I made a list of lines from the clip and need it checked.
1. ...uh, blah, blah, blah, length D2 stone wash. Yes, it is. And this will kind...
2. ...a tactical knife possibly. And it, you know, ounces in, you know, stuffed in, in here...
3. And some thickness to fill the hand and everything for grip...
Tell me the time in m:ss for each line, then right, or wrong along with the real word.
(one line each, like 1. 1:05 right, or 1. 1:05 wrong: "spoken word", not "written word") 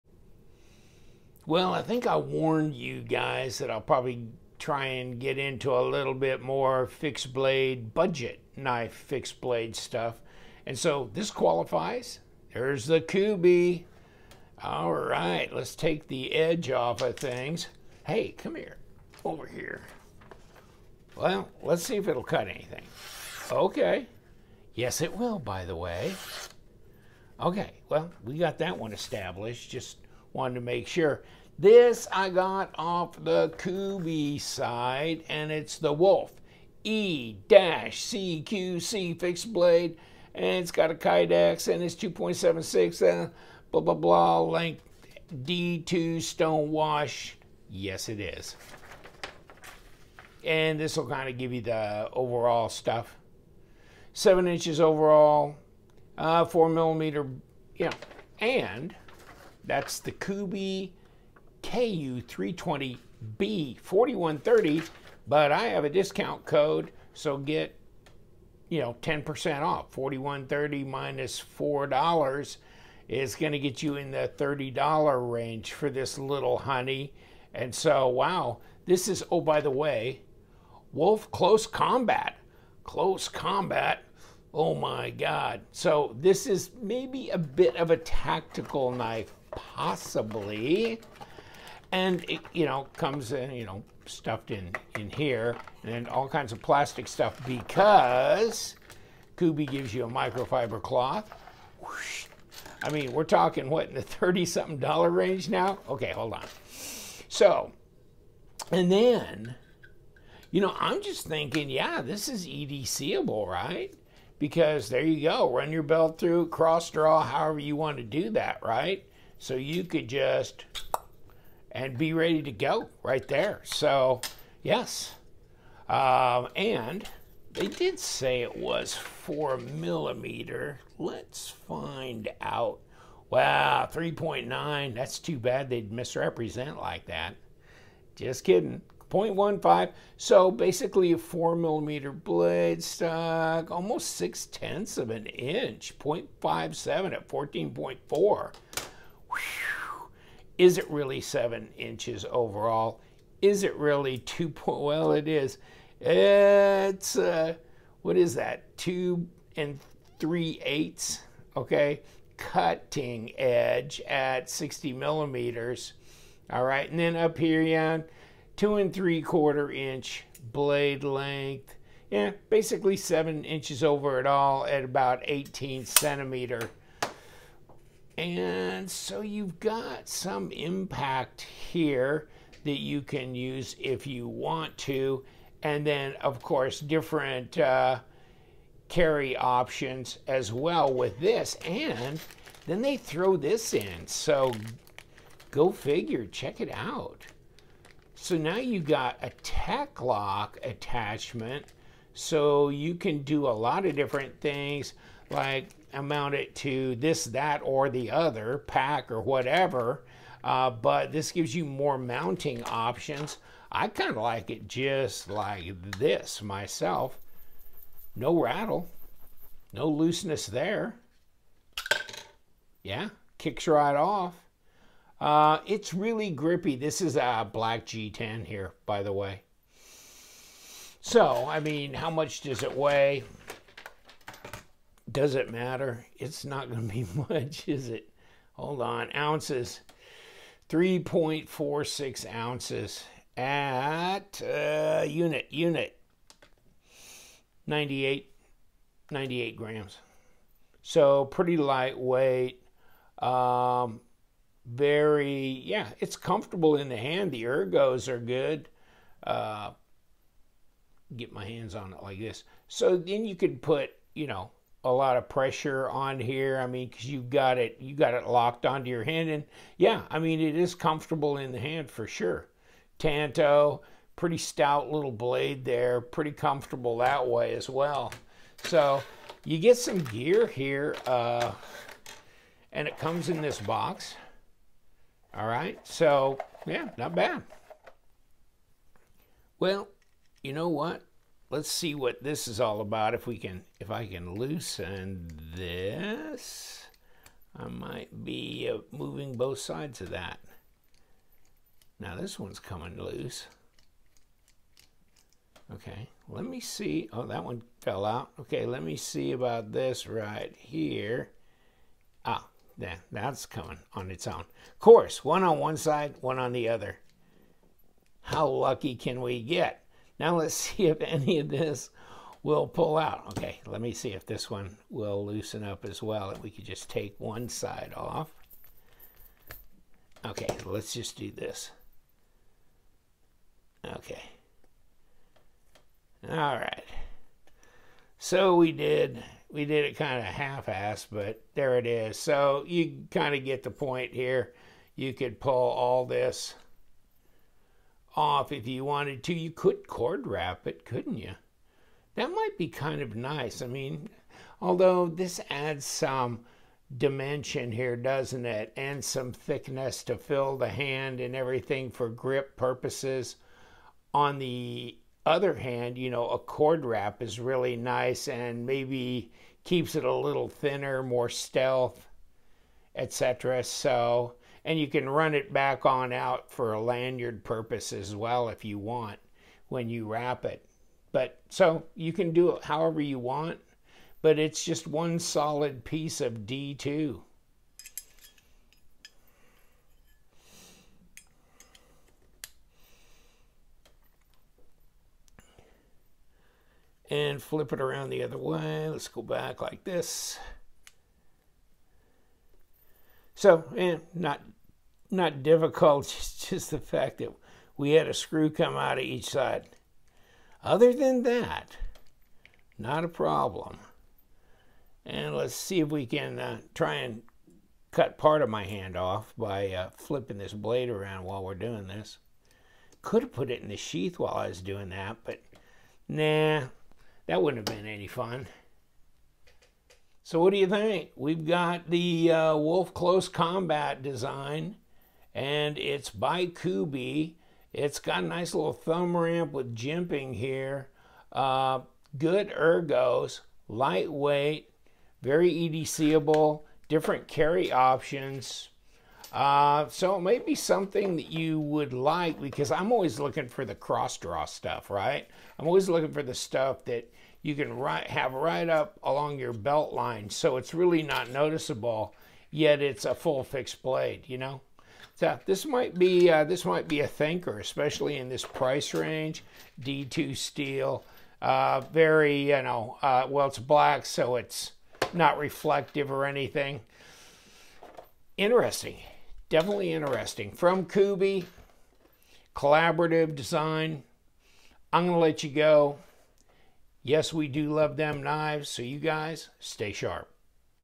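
1. 0:43 right
2. 1:27 wrong: "comes", not "ounces"
3. 5:58 right.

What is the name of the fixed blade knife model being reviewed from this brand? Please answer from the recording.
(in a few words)
Wolf E-CQC.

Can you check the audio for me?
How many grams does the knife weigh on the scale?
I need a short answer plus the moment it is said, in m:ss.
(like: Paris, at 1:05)
98, at 4:09.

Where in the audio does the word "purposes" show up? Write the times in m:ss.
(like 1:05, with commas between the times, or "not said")
6:02, 6:17.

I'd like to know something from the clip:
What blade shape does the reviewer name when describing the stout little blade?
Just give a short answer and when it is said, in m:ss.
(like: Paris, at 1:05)
Tanto, at 4:32.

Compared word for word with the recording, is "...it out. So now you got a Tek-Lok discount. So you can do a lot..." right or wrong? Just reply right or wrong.
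wrong.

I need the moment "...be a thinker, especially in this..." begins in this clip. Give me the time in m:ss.
7:46.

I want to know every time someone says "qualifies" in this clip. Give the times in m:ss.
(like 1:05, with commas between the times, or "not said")
0:11.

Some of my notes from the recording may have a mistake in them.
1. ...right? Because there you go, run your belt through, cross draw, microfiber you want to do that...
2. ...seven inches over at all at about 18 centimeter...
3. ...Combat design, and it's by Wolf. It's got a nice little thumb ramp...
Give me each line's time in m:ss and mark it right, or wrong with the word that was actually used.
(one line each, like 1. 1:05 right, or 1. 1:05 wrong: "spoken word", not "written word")
1. 1:53 wrong: "however", not "microfiber"
2. 2:52 right
3. 7:13 wrong: "Kubey", not "Wolf".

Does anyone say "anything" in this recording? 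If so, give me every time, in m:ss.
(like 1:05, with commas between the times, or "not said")
0:22, 7:56.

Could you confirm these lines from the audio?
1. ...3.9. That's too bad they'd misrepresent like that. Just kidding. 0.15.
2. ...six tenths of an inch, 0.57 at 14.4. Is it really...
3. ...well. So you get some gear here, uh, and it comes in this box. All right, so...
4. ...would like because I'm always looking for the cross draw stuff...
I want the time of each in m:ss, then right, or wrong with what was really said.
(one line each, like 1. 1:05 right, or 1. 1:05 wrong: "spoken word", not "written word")
1. 2:13 right
2. 2:24 right
3. 4:37 right
4. 7:31 right.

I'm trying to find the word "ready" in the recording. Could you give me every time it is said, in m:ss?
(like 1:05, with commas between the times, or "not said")
2:02.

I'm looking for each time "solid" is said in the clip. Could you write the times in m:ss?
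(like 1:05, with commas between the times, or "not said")
6:25.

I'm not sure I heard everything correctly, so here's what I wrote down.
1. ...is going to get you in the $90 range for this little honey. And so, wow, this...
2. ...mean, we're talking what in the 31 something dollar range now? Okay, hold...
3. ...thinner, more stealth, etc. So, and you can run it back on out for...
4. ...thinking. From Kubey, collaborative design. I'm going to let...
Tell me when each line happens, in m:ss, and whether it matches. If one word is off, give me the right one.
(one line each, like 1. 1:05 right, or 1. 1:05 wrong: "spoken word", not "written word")
1. 1:13 wrong: "30", not "90"
2. 1:42 wrong: "30", not "31"
3. 6:10 right
4. 7:59 wrong: "interesting", not "thinking".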